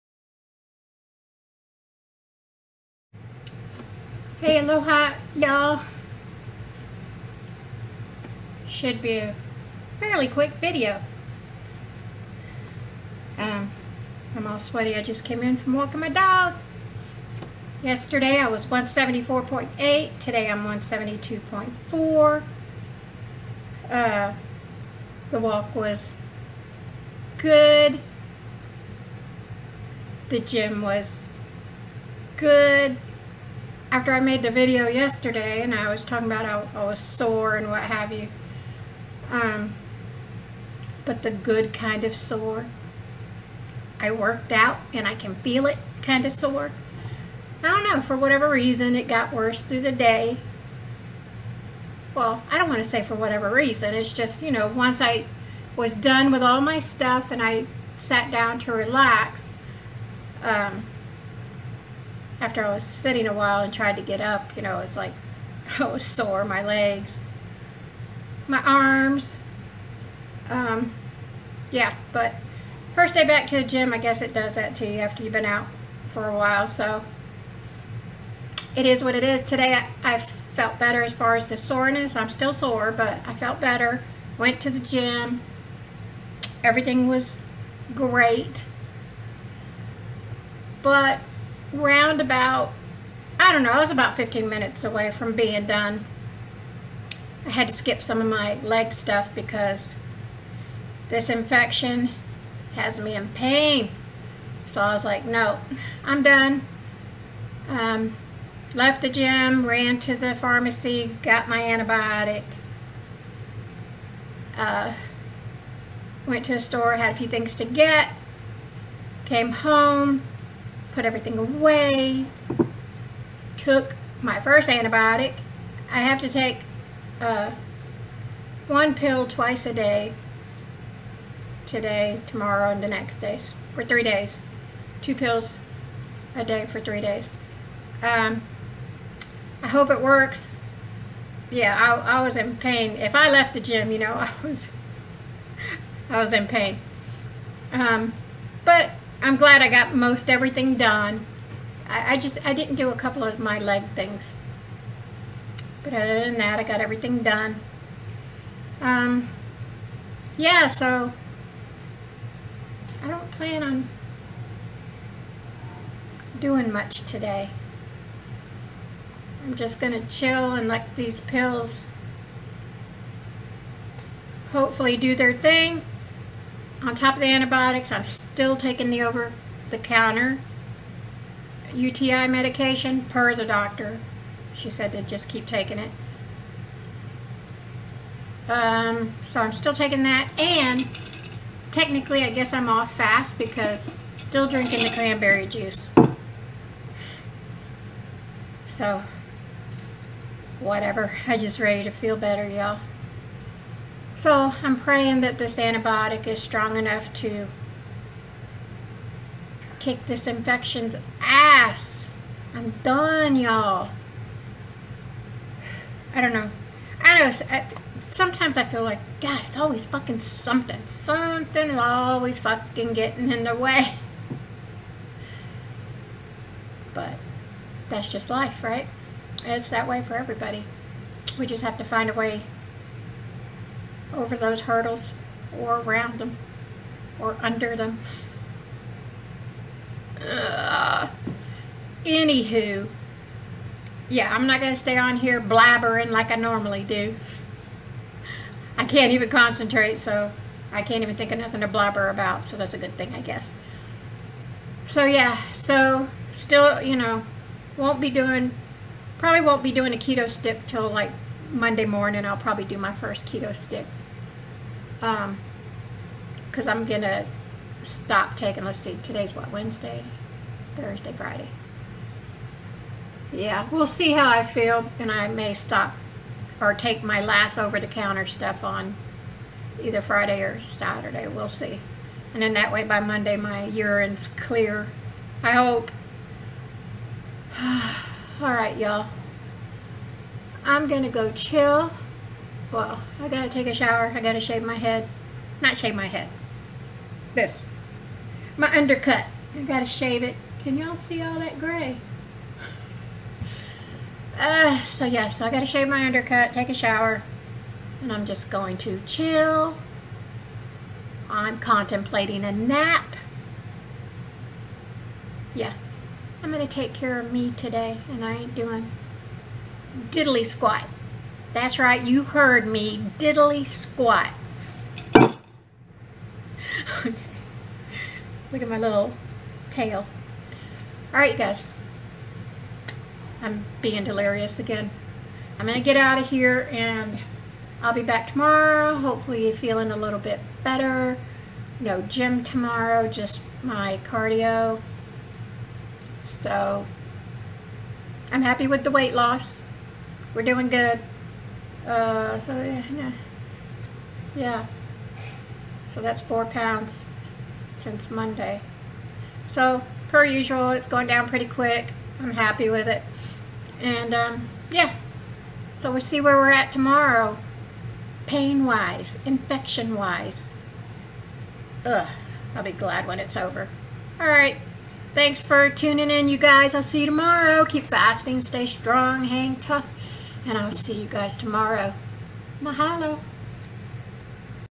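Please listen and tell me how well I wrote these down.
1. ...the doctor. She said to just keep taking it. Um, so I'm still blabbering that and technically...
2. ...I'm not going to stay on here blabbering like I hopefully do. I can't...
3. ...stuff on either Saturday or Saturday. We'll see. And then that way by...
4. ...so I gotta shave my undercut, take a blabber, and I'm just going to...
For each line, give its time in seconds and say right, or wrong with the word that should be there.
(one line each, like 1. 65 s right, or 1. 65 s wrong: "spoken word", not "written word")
1. 183 s wrong: "taking", not "blabbering"
2. 244 s wrong: "normally", not "hopefully"
3. 278 s wrong: "Friday", not "Saturday"
4. 305 s wrong: "shower", not "blabber".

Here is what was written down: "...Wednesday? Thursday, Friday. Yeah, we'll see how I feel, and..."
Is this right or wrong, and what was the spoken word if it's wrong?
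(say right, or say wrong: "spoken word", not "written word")
right.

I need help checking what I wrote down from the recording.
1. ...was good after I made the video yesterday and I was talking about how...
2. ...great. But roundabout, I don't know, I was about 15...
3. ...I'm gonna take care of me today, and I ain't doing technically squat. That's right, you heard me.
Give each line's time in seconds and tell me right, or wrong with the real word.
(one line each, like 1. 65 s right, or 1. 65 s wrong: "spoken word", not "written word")
1. 30 s right
2. 87 s right
3. 316 s wrong: "diddly", not "technically".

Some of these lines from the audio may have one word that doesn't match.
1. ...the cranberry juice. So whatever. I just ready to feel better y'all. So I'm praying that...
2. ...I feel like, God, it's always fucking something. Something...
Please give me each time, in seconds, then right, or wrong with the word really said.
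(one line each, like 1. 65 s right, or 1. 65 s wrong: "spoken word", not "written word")
1. 194 s right
2. 218 s right.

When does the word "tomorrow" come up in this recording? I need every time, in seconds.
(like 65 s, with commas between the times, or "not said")
132 s, 338 s, 342 s, 366 s, 377 s, 381 s.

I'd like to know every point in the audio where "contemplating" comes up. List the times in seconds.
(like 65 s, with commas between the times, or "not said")
311 s.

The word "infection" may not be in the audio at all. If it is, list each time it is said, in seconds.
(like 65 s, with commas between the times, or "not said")
101 s, 210 s, 369 s.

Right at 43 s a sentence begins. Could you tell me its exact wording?
I worked out and I can feel it kind of sore.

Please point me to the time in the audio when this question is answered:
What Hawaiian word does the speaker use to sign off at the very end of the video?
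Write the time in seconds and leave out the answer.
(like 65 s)
382 s.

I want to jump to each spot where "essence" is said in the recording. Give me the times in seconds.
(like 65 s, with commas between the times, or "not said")
not said.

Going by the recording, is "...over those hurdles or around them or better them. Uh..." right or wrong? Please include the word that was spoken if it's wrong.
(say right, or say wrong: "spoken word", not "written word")
wrong: "under", not "better".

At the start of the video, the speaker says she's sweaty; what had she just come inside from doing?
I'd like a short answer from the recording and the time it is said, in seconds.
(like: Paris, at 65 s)
walking my dog, at 15 s.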